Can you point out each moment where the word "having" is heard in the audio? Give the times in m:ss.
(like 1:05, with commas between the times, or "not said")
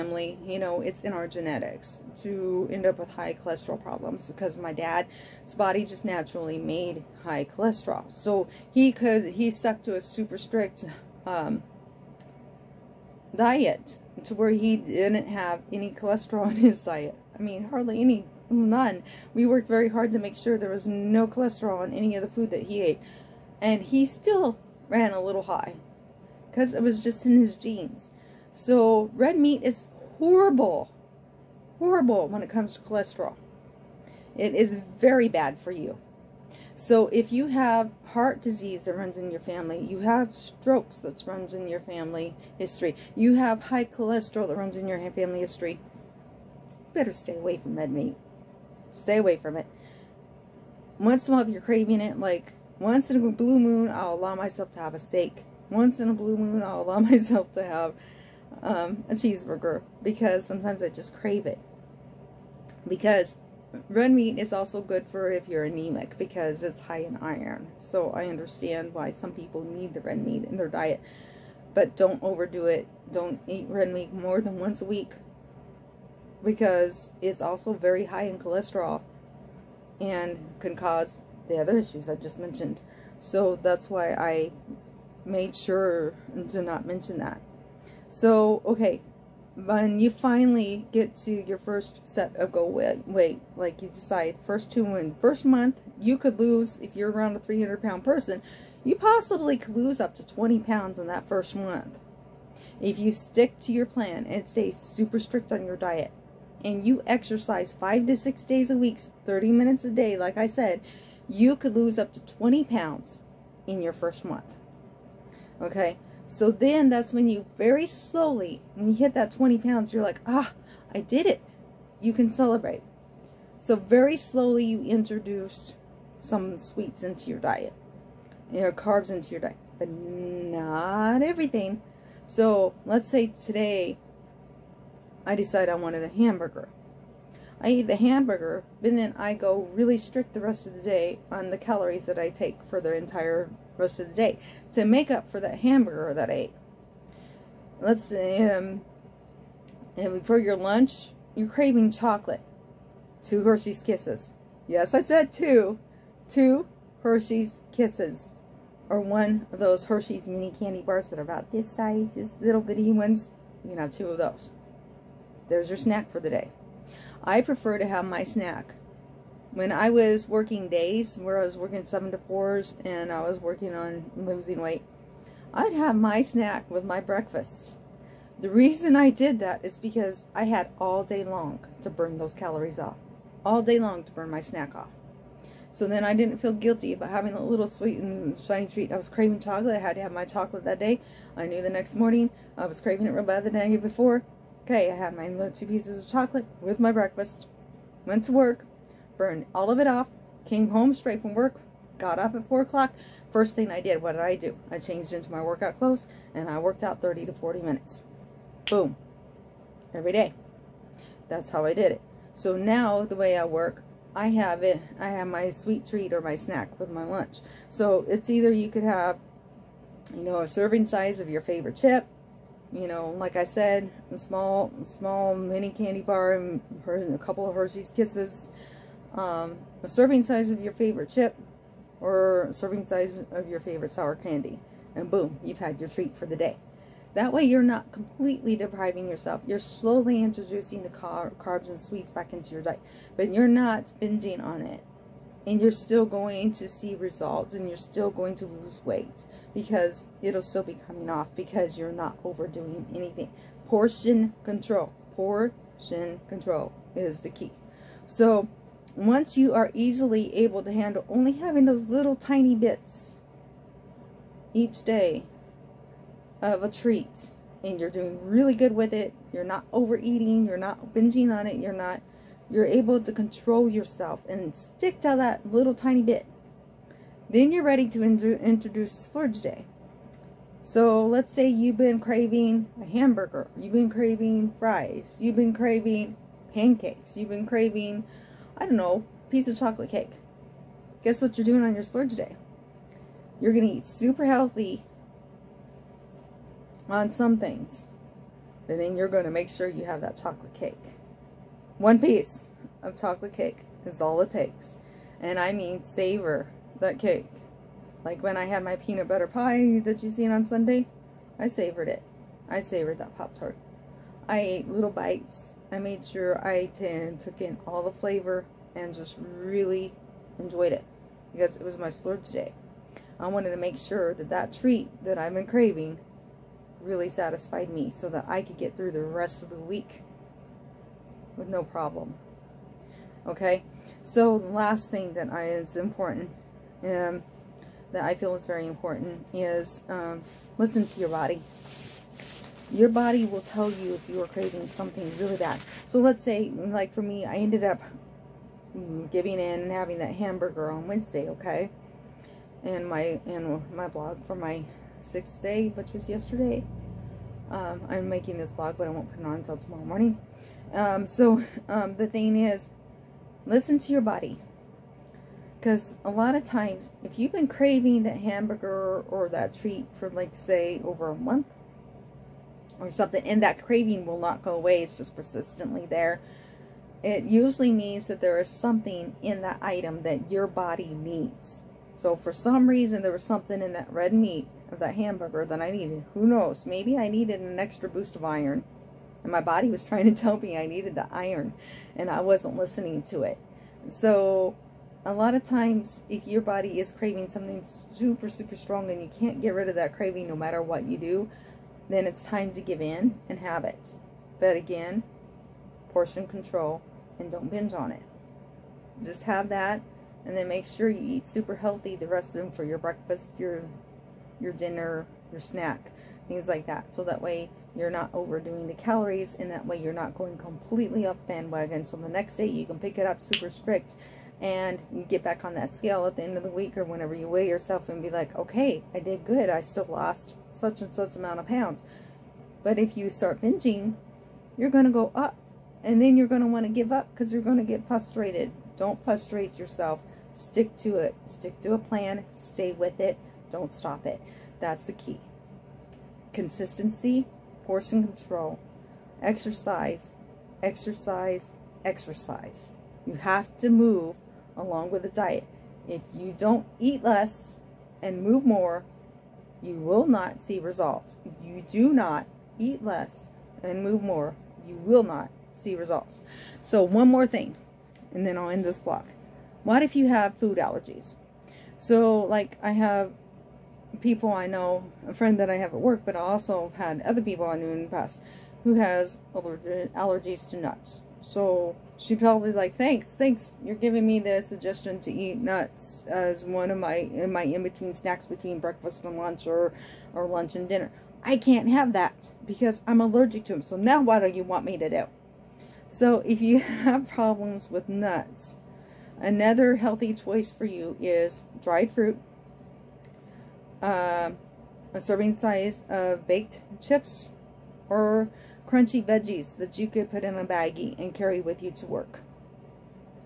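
3:07, 4:21, 5:49.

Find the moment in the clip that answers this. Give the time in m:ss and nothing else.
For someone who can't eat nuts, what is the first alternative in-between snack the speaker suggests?
8:21.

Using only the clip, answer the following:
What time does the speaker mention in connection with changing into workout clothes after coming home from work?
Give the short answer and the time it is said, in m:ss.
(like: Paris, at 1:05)
4 o'clock, at 3:22.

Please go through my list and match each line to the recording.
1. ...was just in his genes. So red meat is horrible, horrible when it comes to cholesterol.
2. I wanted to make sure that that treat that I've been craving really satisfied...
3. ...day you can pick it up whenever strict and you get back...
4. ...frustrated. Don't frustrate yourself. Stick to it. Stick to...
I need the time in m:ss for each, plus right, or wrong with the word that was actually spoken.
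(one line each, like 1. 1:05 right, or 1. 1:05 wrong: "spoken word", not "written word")
1. 0:26 right
2. 5:23 right
3. 7:02 wrong: "super", not "whenever"
4. 7:17 right.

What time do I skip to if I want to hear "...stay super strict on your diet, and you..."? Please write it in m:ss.
1:44.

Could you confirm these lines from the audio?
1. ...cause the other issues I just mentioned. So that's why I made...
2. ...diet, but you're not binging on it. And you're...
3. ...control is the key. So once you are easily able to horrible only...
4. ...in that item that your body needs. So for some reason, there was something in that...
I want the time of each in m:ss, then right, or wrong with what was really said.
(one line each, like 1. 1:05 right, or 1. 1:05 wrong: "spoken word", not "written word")
1. 1:20 right
2. 4:02 right
3. 4:16 wrong: "handle", not "horrible"
4. 6:19 right.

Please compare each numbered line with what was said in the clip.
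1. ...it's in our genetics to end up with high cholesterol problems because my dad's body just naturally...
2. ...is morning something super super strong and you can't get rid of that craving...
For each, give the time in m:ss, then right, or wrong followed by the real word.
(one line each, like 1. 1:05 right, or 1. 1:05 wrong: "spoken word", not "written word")
1. 0:00 right
2. 6:36 wrong: "craving", not "morning".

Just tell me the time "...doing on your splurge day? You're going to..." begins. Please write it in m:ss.
4:51.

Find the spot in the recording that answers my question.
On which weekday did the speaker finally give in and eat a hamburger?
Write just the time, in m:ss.
5:50.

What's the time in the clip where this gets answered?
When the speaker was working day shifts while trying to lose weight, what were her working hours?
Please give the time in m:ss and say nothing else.
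2:51.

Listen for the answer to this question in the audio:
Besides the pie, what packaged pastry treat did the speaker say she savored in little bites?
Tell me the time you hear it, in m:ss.
5:13.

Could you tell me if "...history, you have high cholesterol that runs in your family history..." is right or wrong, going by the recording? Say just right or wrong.
right.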